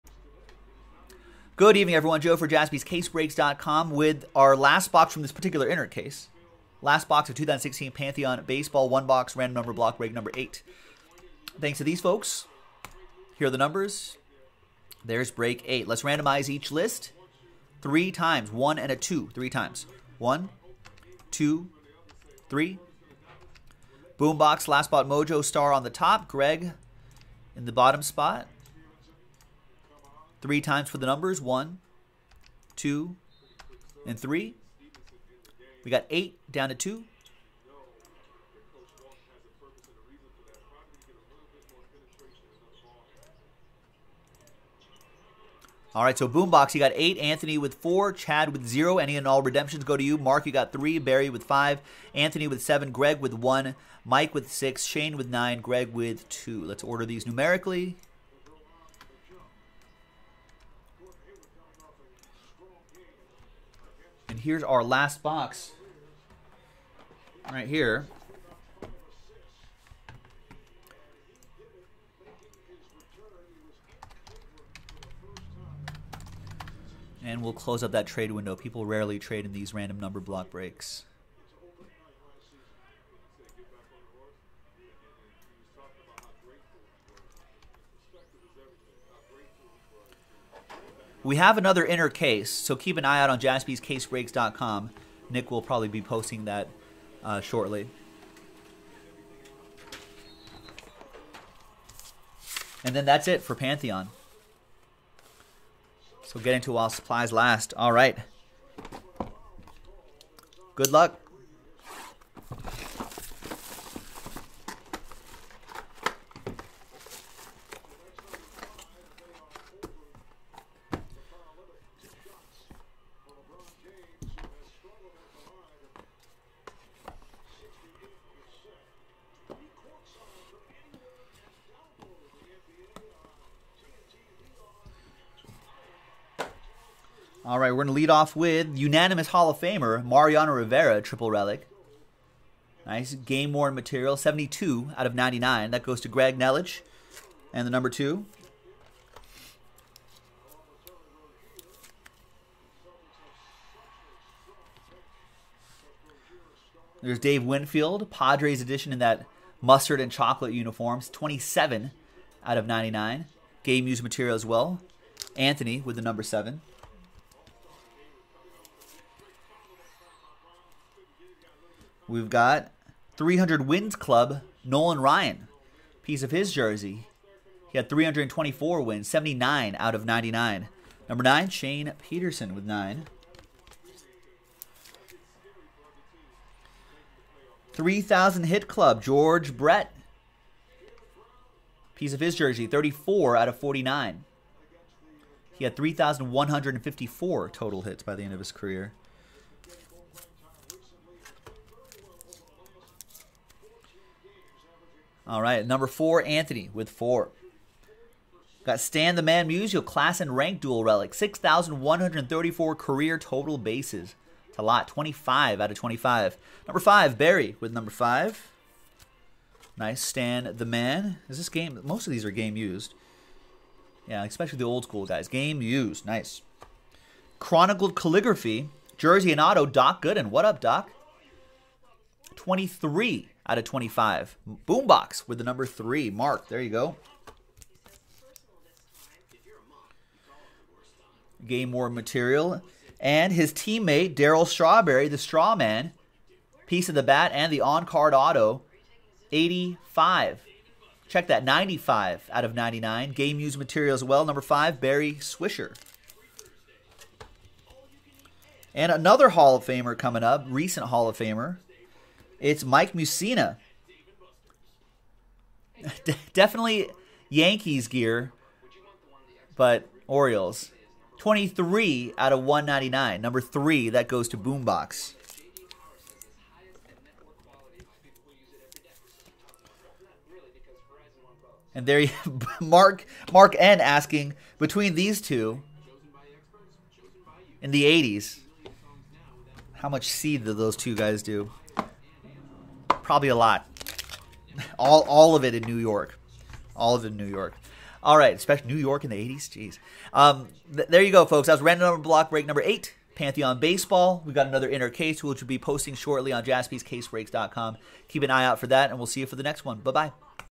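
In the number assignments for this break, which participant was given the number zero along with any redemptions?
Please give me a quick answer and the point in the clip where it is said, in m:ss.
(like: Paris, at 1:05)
Chad, at 0:48.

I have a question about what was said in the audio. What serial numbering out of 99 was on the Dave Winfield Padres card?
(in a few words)
27.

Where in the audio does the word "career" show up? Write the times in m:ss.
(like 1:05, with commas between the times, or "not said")
3:18, 3:32.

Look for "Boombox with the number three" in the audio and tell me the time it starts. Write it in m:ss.
3:54.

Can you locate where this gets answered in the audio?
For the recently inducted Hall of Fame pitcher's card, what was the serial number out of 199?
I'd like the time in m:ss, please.
4:31.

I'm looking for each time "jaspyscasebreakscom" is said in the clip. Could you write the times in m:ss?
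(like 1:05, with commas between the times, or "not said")
0:02, 1:33, 5:06.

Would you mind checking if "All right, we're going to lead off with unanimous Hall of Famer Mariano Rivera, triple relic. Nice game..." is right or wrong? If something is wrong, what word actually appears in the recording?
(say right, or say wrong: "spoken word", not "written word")
right.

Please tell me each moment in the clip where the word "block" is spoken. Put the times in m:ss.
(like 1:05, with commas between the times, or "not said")
0:09, 1:20, 5:02.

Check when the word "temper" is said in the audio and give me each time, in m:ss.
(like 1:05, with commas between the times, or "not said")
not said.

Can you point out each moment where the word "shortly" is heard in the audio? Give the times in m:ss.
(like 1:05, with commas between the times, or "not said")
1:37, 5:05.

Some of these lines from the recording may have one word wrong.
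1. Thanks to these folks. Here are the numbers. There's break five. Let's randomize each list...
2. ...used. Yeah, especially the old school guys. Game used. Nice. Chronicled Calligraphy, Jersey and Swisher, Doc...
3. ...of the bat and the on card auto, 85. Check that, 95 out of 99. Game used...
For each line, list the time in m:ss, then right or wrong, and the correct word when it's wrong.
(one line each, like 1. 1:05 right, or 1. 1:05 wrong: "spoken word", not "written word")
1. 0:11 wrong: "eight", not "five"
2. 3:42 wrong: "Auto", not "Swisher"
3. 4:06 right.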